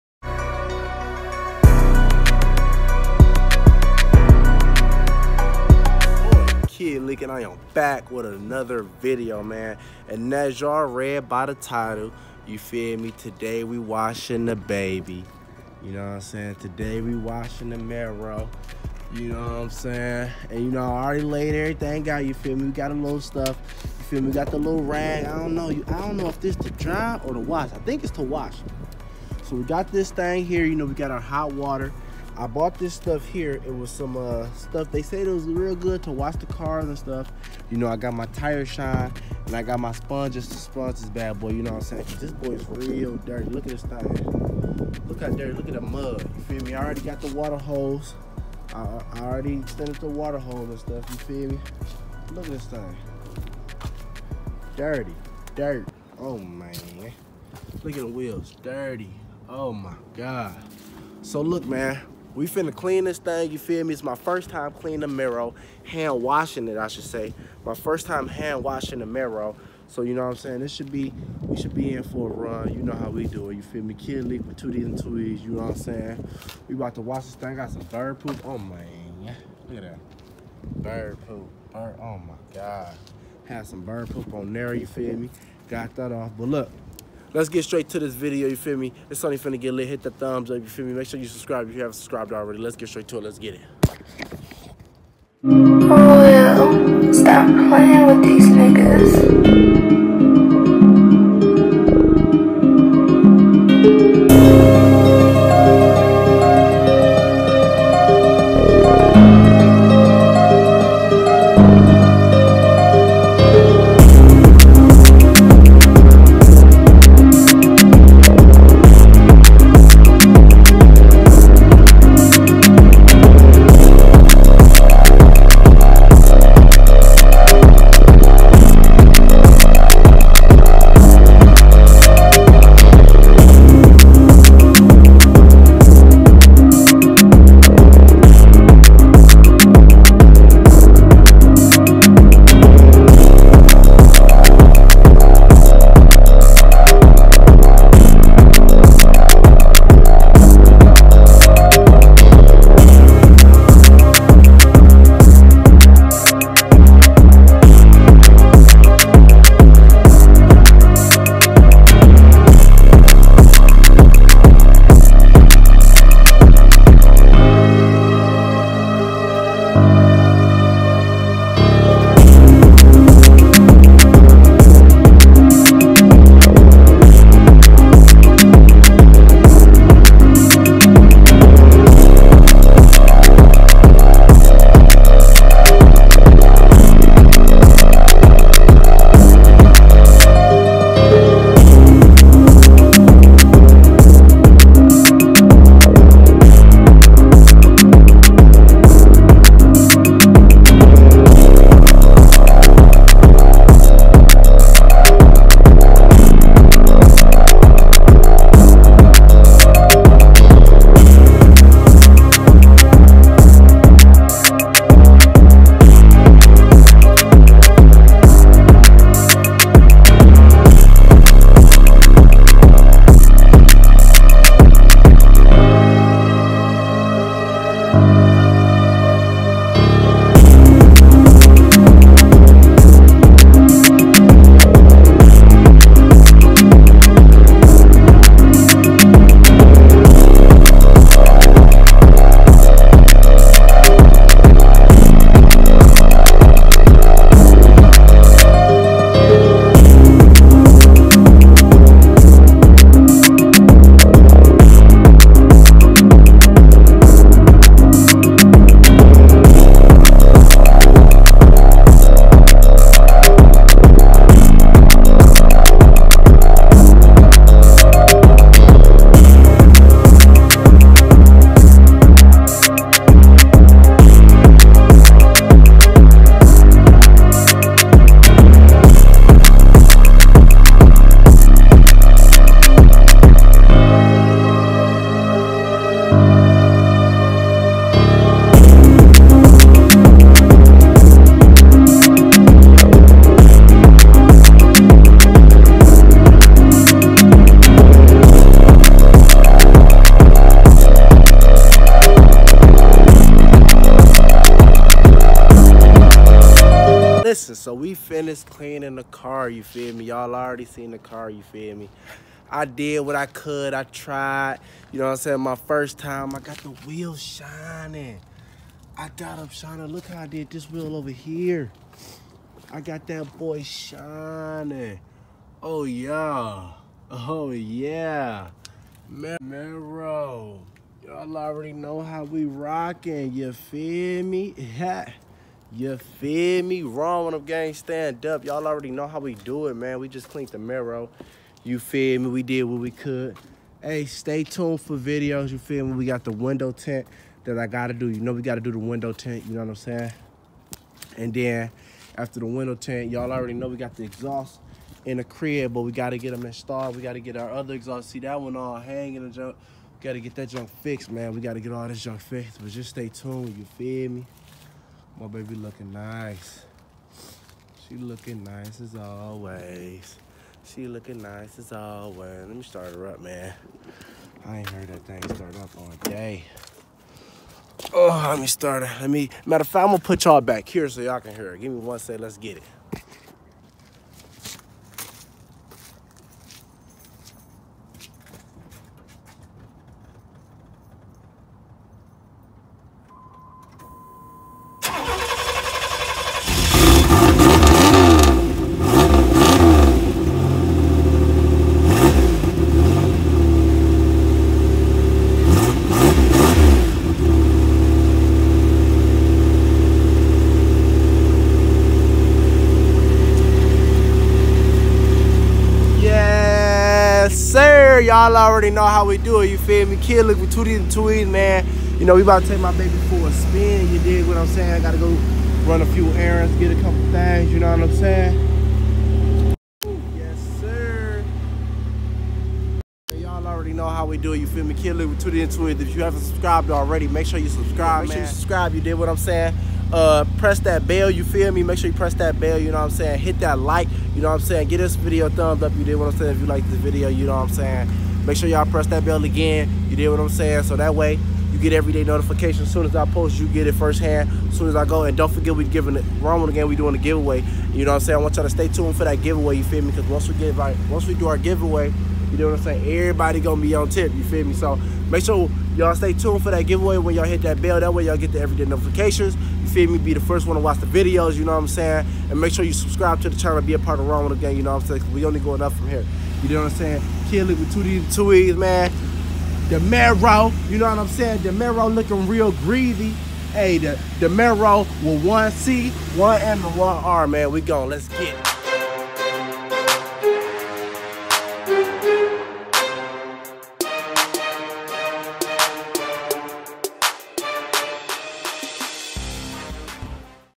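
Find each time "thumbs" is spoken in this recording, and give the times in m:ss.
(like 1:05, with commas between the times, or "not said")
1:30, 7:25.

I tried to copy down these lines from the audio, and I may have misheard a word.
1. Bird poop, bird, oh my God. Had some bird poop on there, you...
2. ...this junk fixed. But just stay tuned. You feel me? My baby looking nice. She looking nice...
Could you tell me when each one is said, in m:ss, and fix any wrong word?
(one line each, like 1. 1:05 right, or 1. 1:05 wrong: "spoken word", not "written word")
1. 1:20 right
2. 6:01 right.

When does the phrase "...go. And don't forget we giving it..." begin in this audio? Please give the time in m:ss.
7:34.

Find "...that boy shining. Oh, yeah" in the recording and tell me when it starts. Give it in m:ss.
5:23.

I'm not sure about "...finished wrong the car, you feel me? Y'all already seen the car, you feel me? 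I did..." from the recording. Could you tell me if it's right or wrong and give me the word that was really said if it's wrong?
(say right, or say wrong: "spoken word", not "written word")
wrong: "cleaning", not "wrong".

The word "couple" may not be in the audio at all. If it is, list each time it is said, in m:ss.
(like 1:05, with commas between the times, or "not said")
7:06.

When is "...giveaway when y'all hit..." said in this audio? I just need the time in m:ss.
7:46.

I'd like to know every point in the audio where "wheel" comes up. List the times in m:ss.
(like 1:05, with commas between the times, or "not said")
0:58, 5:16, 5:20.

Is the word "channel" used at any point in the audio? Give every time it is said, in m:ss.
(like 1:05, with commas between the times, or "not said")
7:53.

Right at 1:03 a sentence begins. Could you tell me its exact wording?
It's my first time cleaning the mirror, hand washing it, I should say.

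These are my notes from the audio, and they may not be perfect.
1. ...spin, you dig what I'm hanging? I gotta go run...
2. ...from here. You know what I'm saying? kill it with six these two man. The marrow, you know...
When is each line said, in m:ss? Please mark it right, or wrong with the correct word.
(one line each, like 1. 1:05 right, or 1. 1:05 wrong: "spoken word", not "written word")
1. 7:03 wrong: "saying", not "hanging"
2. 7:55 wrong: "two", not "six".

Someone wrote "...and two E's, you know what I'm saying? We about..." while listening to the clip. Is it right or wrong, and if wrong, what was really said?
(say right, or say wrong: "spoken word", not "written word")
right.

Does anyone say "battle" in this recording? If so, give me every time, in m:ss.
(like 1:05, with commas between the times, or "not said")
not said.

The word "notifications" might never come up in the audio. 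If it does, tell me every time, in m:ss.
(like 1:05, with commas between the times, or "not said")
7:32, 7:48.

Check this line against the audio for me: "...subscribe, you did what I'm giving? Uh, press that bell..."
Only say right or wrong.
wrong.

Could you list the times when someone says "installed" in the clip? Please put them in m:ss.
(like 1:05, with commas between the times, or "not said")
5:56.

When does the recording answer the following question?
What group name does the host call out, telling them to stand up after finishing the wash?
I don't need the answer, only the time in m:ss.
5:36.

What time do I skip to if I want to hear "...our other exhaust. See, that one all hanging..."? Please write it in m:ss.
5:57.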